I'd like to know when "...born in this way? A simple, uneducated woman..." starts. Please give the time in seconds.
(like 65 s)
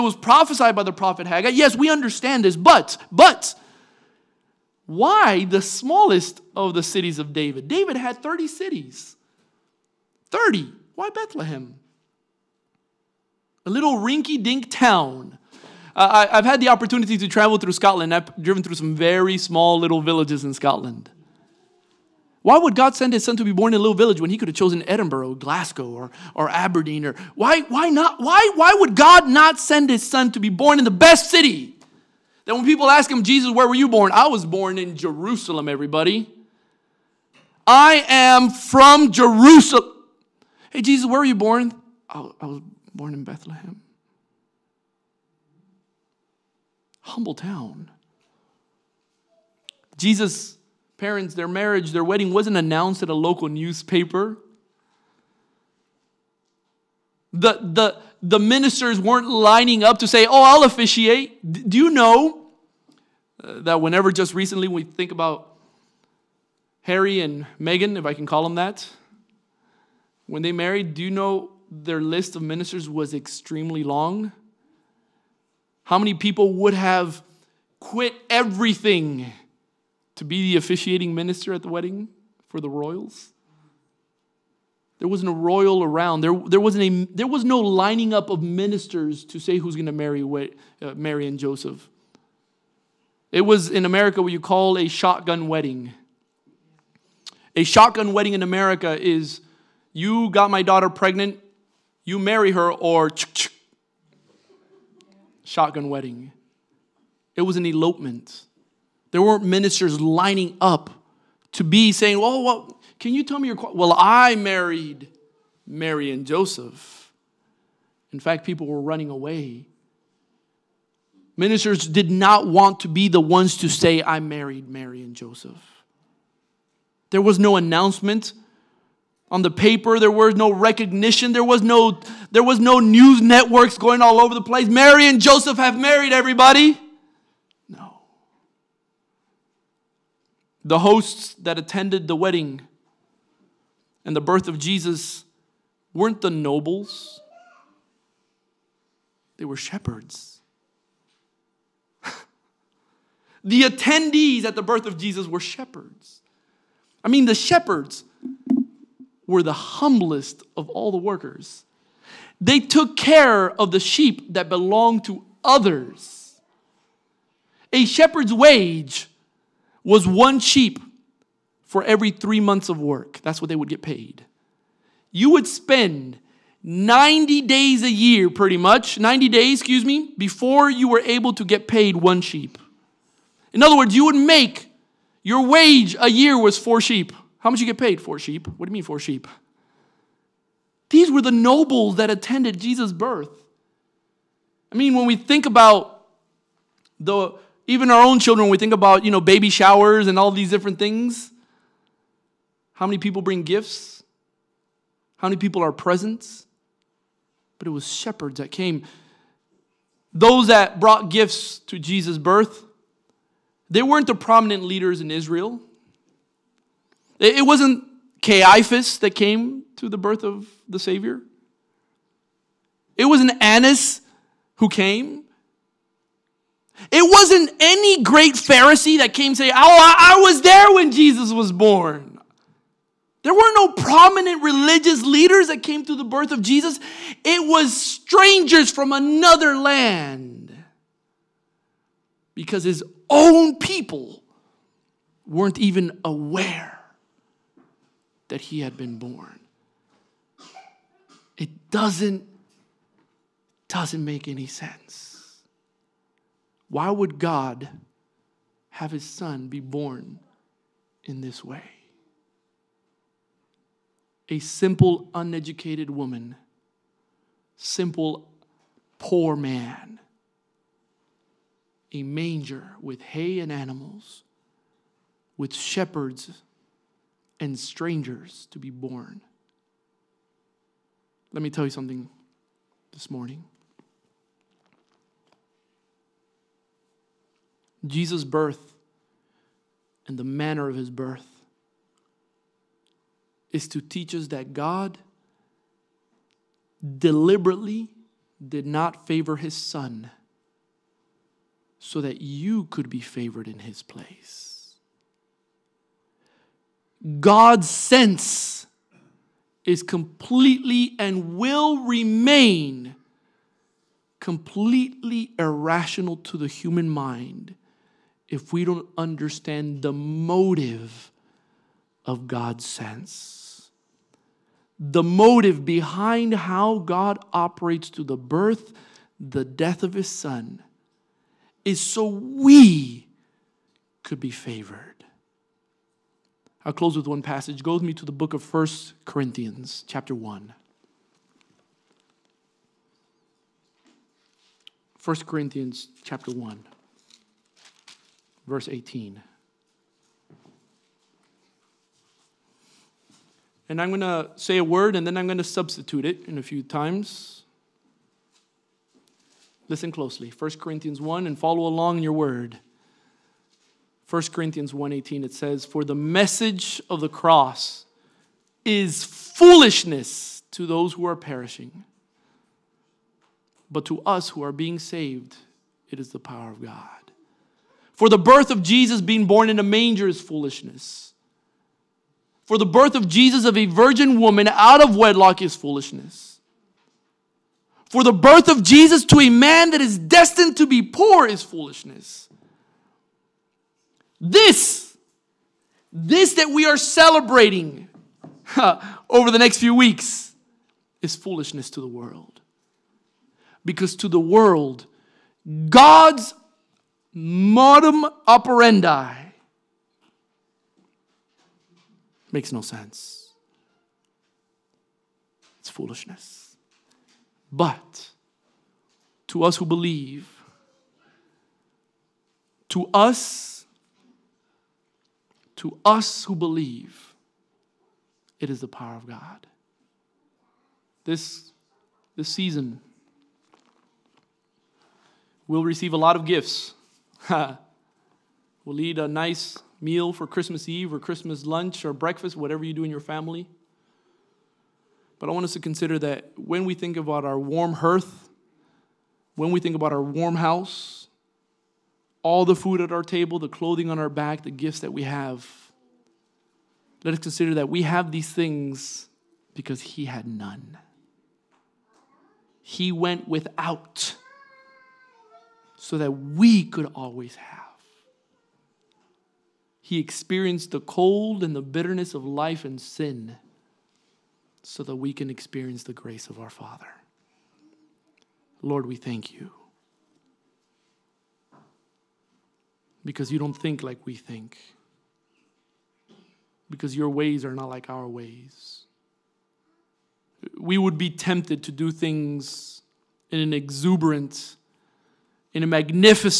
259 s.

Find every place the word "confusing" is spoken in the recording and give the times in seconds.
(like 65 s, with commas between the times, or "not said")
not said.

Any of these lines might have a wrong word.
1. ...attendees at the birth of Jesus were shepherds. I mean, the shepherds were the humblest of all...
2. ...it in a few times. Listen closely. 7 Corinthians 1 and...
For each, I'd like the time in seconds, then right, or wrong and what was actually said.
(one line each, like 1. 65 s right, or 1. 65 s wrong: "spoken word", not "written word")
1. 153 s right
2. 356 s wrong: "1", not "7".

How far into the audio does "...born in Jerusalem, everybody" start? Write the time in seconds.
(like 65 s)
34 s.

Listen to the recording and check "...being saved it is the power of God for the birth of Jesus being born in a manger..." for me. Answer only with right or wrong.
right.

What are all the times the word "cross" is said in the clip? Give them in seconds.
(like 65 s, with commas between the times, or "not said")
367 s.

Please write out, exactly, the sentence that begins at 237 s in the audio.
It was strangers from another land because his own people weren't even aware that he had been born.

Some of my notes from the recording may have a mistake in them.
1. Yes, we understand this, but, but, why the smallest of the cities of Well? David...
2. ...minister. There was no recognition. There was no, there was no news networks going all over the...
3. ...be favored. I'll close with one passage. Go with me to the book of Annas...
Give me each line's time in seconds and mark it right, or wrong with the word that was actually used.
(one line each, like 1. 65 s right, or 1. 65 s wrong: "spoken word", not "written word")
1. 1 s wrong: "David", not "Well"
2. 129 s wrong: "paper", not "minister"
3. 334 s wrong: "First", not "Annas".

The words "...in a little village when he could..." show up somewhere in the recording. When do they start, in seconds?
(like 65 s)
23 s.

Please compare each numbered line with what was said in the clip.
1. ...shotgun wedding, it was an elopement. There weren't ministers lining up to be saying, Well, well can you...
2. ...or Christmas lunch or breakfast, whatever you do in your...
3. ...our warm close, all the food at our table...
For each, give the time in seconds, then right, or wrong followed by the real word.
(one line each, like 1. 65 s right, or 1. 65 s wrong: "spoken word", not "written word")
1. 105 s right
2. 440 s right
3. 449 s wrong: "house", not "close".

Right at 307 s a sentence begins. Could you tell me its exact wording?
God's sense is completely and will remain completely irrational to the human mind if we don't understand the motive of God's sense.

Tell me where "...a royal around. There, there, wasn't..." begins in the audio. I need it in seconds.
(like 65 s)
85 s.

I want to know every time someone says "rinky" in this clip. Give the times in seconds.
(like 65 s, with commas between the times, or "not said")
13 s.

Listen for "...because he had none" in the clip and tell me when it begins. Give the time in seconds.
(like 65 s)
459 s.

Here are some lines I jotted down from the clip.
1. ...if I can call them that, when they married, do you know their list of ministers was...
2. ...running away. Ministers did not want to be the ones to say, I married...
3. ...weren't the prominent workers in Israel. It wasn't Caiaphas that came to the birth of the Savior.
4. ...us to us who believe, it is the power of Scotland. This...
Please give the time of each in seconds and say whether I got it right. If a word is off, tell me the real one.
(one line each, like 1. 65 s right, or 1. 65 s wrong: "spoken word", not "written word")
1. 67 s right
2. 118 s right
3. 213 s wrong: "leaders", not "workers"
4. 422 s wrong: "God", not "Scotland".